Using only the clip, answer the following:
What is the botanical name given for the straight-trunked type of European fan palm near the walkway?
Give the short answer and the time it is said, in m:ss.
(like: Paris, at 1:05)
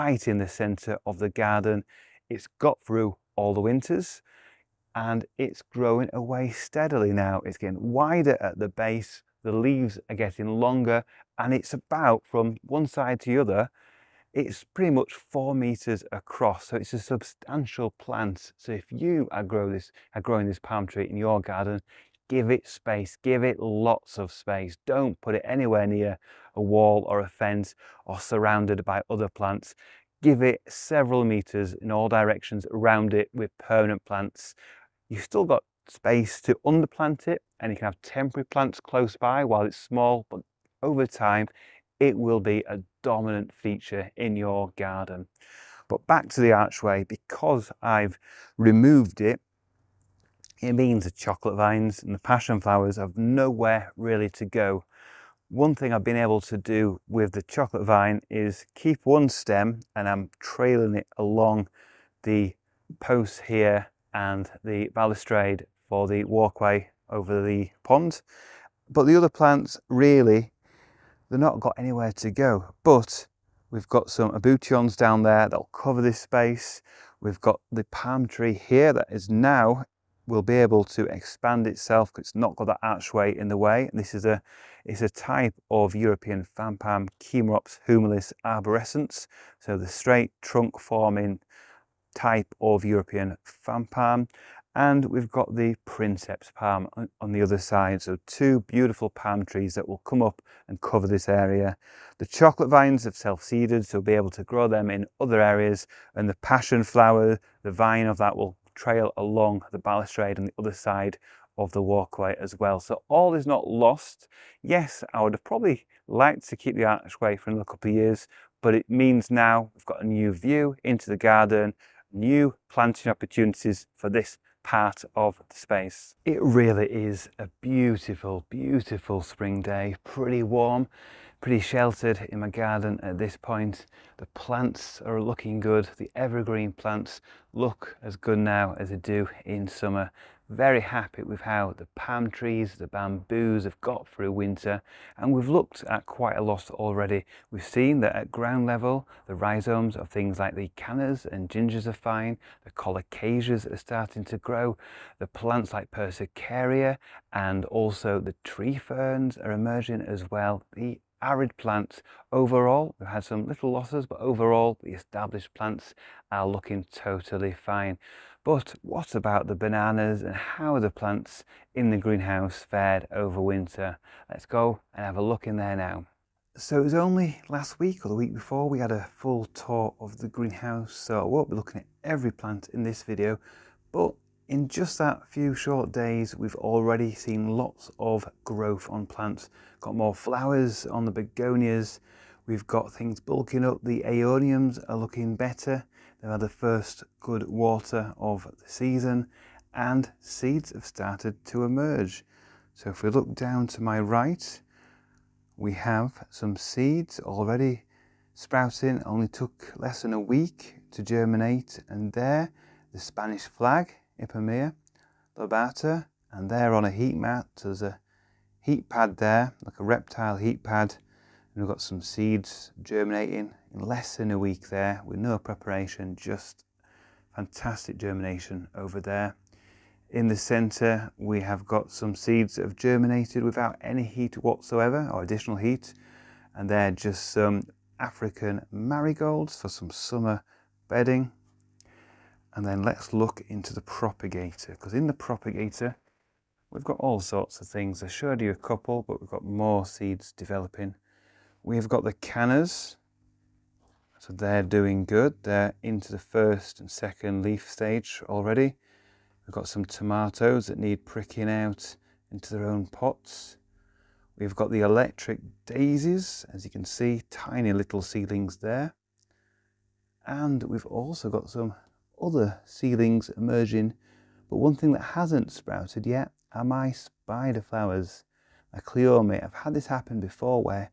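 Chamaerops humilis arborescens, at 1:27.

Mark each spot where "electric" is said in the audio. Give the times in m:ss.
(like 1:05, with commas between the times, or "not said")
4:24.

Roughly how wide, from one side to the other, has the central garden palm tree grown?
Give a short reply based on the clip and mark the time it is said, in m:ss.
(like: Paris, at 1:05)
4 meters, at 0:15.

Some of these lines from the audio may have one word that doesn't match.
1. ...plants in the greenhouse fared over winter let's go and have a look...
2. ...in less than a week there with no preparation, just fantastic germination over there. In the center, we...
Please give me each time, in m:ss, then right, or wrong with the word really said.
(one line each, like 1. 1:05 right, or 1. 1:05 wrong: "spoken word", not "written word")
1. 2:50 right
2. 3:43 right.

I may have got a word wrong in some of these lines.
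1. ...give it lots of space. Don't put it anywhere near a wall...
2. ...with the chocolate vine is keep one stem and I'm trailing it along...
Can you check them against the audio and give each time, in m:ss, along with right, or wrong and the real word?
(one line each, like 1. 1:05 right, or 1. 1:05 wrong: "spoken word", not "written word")
1. 0:23 right
2. 0:57 right.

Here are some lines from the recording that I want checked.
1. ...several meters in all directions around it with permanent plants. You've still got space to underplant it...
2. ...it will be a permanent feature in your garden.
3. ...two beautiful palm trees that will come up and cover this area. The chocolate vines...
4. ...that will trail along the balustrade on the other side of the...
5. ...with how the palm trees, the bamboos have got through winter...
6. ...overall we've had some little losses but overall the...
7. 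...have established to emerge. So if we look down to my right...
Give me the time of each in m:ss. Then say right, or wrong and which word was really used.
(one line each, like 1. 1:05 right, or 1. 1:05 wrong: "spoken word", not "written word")
1. 0:30 right
2. 0:41 wrong: "dominant", not "permanent"
3. 1:38 right
4. 1:48 right
5. 2:21 right
6. 2:42 right
7. 3:20 wrong: "started", not "established".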